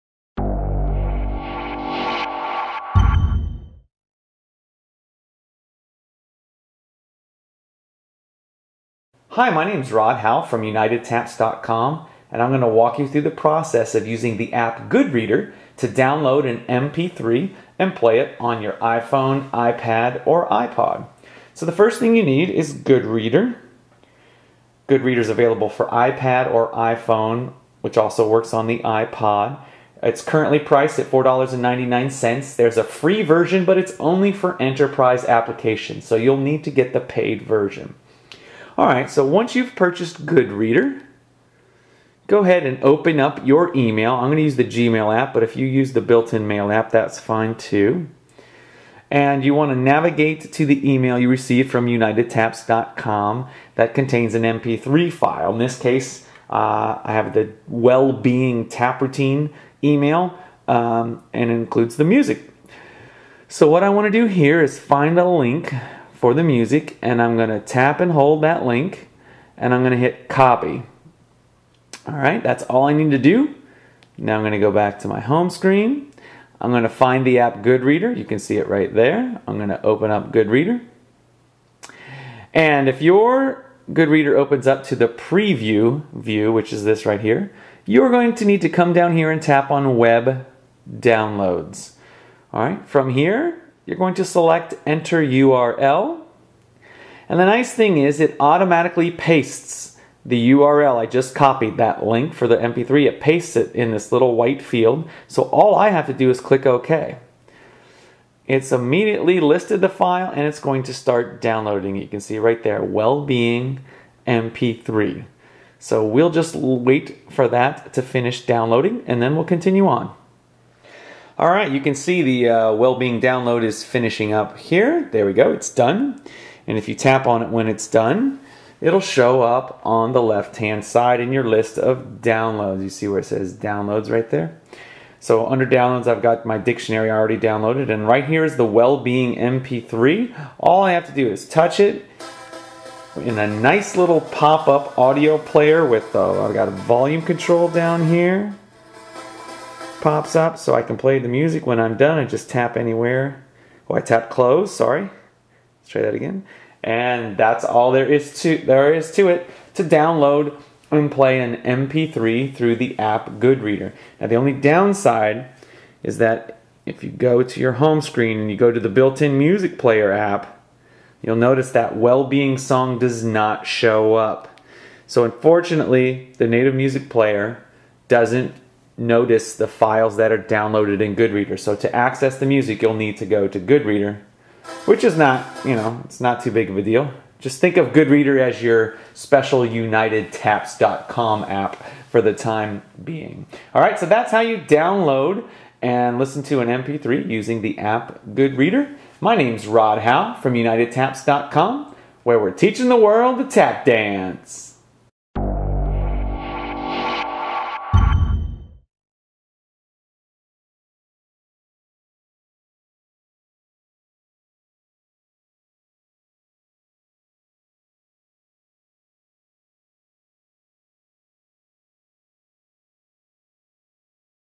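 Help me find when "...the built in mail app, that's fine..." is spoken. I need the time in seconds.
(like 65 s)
45 s.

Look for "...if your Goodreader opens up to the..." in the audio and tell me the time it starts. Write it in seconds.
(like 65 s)
82 s.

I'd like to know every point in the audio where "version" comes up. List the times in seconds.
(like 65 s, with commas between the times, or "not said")
33 s, 37 s.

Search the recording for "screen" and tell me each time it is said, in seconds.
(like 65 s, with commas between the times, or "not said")
75 s, 168 s.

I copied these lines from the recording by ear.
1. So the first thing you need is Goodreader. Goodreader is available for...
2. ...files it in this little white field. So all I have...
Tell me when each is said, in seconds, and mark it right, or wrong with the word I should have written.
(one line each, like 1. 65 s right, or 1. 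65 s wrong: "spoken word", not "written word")
1. 21 s right
2. 103 s wrong: "pastes", not "files".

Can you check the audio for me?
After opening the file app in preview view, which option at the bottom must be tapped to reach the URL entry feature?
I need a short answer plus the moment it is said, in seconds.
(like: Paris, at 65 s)
web downloads, at 89 s.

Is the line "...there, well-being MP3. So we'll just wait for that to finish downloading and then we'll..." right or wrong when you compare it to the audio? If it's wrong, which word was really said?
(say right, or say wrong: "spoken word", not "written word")
right.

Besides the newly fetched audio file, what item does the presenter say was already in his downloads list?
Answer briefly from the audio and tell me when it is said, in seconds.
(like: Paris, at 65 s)
dictionary, at 136 s.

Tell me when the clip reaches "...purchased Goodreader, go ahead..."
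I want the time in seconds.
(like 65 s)
39 s.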